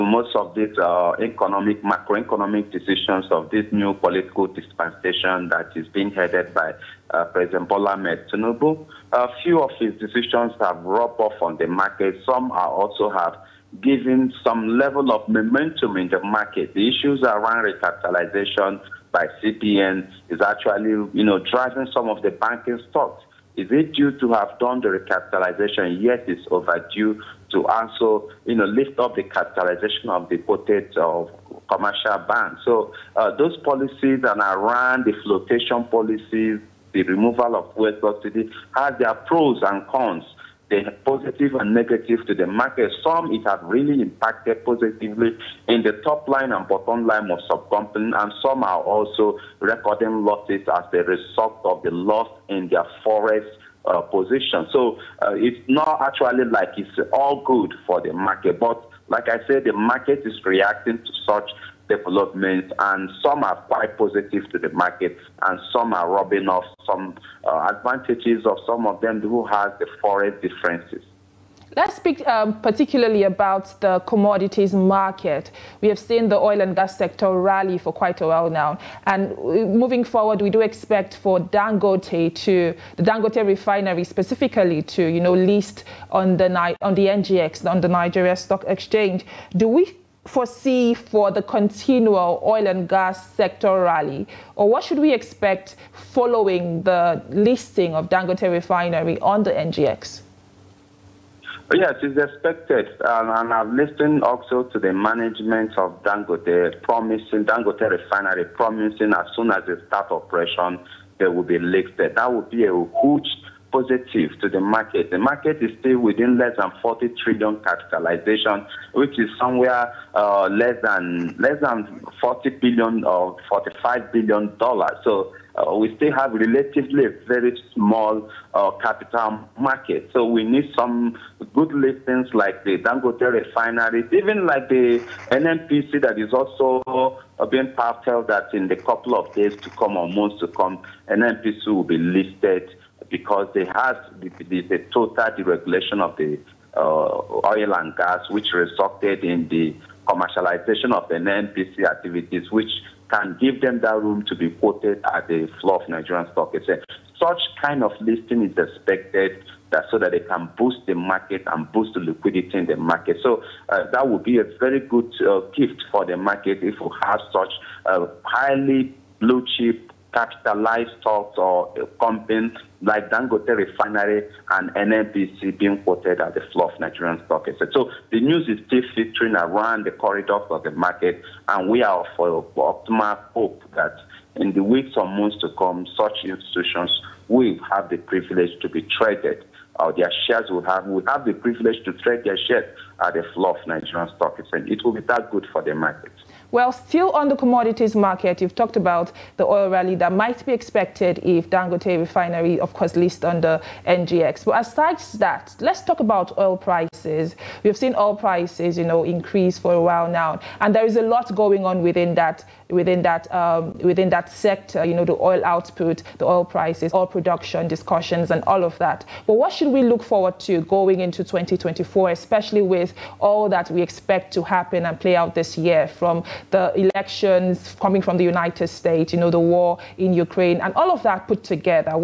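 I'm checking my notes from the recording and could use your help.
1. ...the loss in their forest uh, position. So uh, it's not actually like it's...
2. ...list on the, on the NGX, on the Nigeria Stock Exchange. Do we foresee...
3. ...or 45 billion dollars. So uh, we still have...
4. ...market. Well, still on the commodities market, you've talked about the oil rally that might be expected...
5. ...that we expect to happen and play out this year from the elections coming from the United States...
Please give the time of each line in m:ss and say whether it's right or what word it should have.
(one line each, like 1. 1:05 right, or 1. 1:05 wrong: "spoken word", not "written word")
1. 0:51 right
2. 1:25 right
3. 2:03 right
4. 3:15 right
5. 3:43 right.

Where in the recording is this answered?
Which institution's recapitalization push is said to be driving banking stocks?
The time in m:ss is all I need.
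0:19.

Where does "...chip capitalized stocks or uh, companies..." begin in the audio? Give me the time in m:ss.
2:49.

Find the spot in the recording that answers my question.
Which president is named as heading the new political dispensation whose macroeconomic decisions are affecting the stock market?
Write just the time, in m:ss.
0:07.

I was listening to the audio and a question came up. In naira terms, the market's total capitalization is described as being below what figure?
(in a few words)
40 trillion.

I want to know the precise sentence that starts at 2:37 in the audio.
Such kind of listing is expected that so that they can boost the market and boost the liquidity in the market.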